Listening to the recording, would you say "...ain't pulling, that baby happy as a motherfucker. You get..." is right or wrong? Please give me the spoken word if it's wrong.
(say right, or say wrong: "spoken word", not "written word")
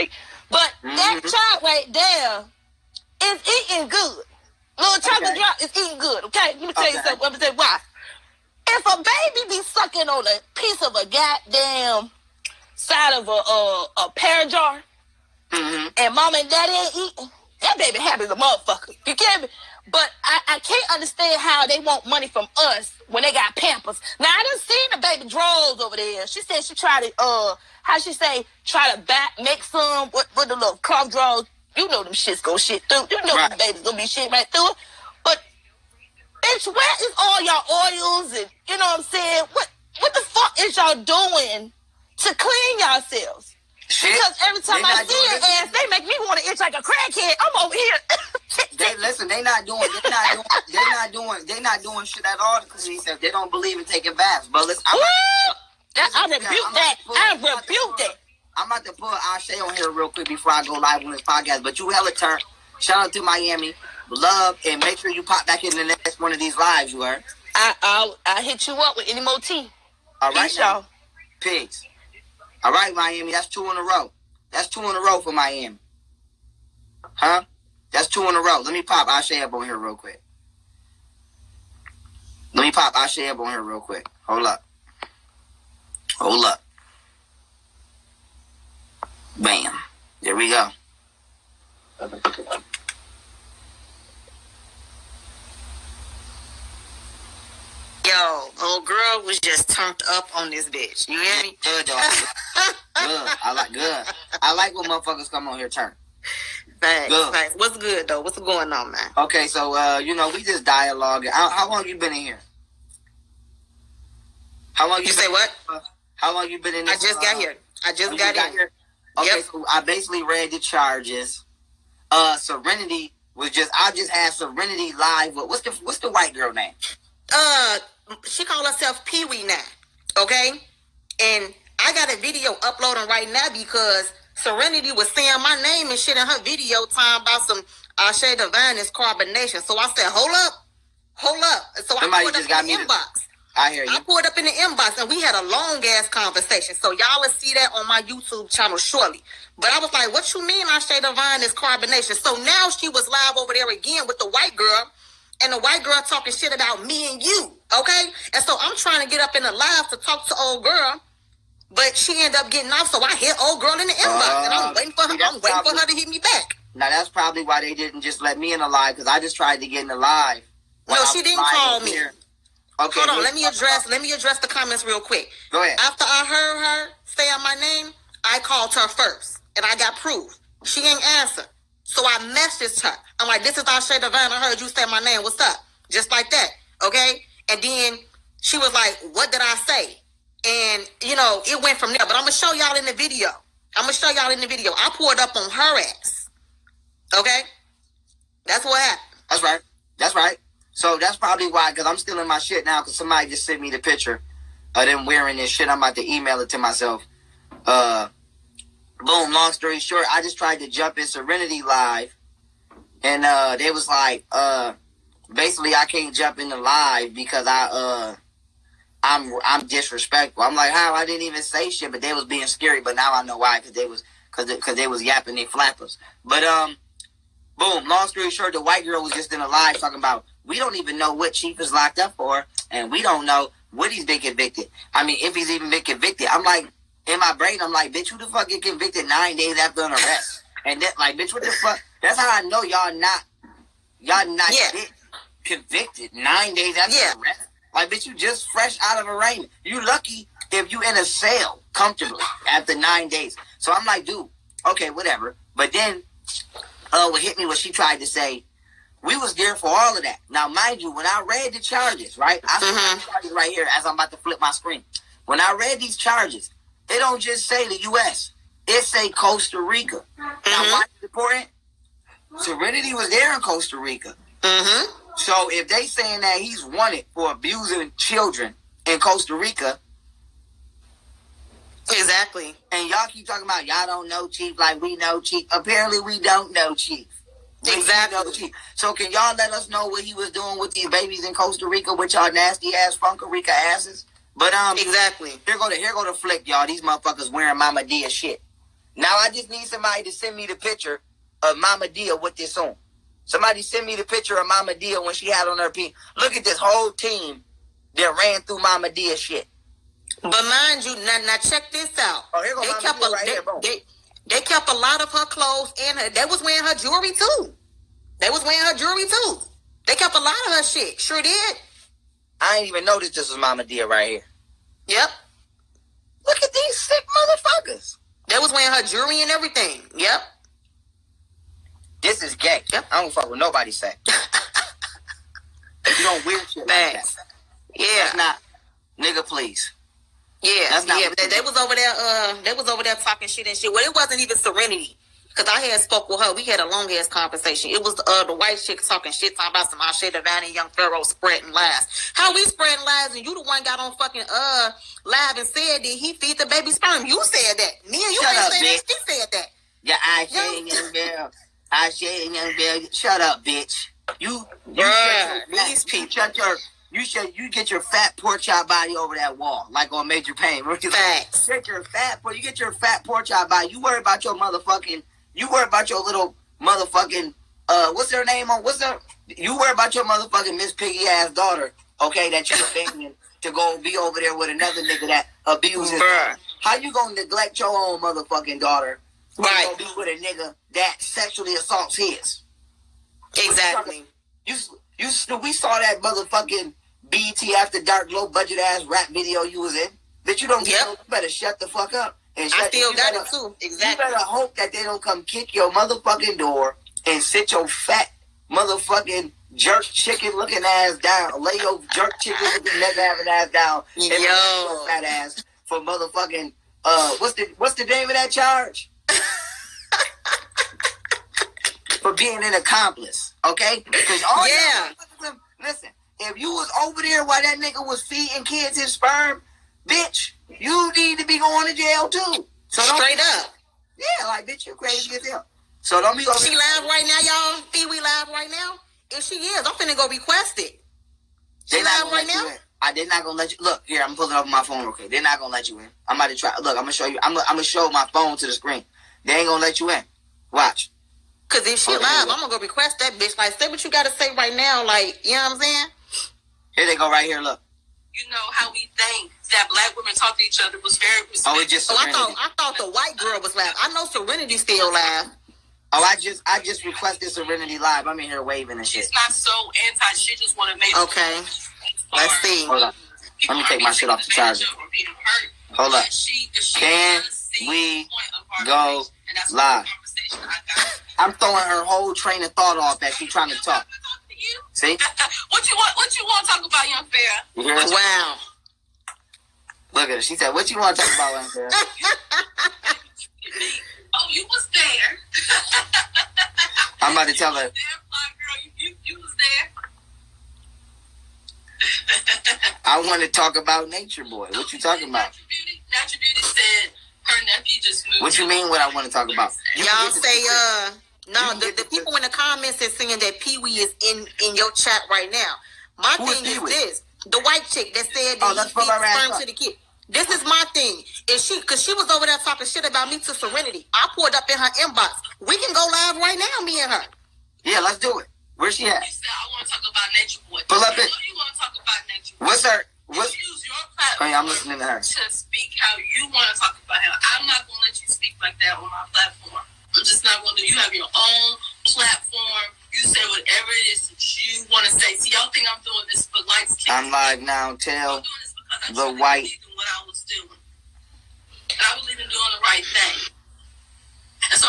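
wrong: "eating", not "pulling".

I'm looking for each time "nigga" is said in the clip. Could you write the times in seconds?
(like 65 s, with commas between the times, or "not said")
338 s, 384 s, 390 s, 427 s.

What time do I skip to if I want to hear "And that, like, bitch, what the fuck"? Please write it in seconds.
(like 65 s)
240 s.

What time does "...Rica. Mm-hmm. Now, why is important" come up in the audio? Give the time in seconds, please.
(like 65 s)
269 s.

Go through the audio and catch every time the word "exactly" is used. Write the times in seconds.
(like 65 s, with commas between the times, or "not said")
281 s, 287 s, 294 s, 393 s, 403 s.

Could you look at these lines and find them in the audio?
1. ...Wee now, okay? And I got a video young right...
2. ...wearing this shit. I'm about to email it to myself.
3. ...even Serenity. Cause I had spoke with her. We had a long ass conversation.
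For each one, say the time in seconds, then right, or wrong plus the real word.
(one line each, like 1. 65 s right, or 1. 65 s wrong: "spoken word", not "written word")
1. 129 s wrong: "uploading", not "young"
2. 205 s right
3. 344 s right.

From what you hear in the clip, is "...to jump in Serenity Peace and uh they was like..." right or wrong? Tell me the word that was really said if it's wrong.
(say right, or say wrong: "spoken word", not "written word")
wrong: "Live", not "Peace".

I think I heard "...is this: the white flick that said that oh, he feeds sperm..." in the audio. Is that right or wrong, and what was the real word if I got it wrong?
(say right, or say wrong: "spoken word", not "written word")
wrong: "chick", not "flick".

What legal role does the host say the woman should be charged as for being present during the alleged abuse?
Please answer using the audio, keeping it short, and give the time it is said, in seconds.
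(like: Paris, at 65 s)
Accomplice, at 422 s.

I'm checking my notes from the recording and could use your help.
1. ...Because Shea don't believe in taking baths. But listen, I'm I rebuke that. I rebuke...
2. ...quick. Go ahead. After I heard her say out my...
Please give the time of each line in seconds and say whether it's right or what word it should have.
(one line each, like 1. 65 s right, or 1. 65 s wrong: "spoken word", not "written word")
1. 52 s wrong: "They", not "Shea"
2. 174 s right.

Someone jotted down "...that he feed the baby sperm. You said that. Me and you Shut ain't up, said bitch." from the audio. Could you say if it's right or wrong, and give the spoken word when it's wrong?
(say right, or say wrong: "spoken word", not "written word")
right.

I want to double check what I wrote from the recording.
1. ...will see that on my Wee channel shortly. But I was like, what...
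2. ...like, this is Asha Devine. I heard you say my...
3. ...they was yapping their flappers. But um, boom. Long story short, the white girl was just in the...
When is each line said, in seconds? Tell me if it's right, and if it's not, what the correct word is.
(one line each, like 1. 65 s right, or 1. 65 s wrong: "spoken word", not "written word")
1. 147 s wrong: "YouTube", not "Wee"
2. 183 s right
3. 224 s right.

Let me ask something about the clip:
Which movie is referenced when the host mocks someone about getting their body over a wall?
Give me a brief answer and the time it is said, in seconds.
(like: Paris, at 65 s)
Major Payne, at 370 s.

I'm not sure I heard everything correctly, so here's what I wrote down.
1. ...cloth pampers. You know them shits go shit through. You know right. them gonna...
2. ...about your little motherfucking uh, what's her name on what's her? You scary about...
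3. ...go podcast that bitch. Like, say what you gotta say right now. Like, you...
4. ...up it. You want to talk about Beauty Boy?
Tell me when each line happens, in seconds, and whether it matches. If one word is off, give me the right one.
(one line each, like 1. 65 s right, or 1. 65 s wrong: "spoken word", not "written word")
1. 30 s wrong: "drawers", not "pampers"
2. 375 s wrong: "worry", not "scary"
3. 452 s wrong: "request", not "podcast"
4. 530 s wrong: "Nature", not "Beauty".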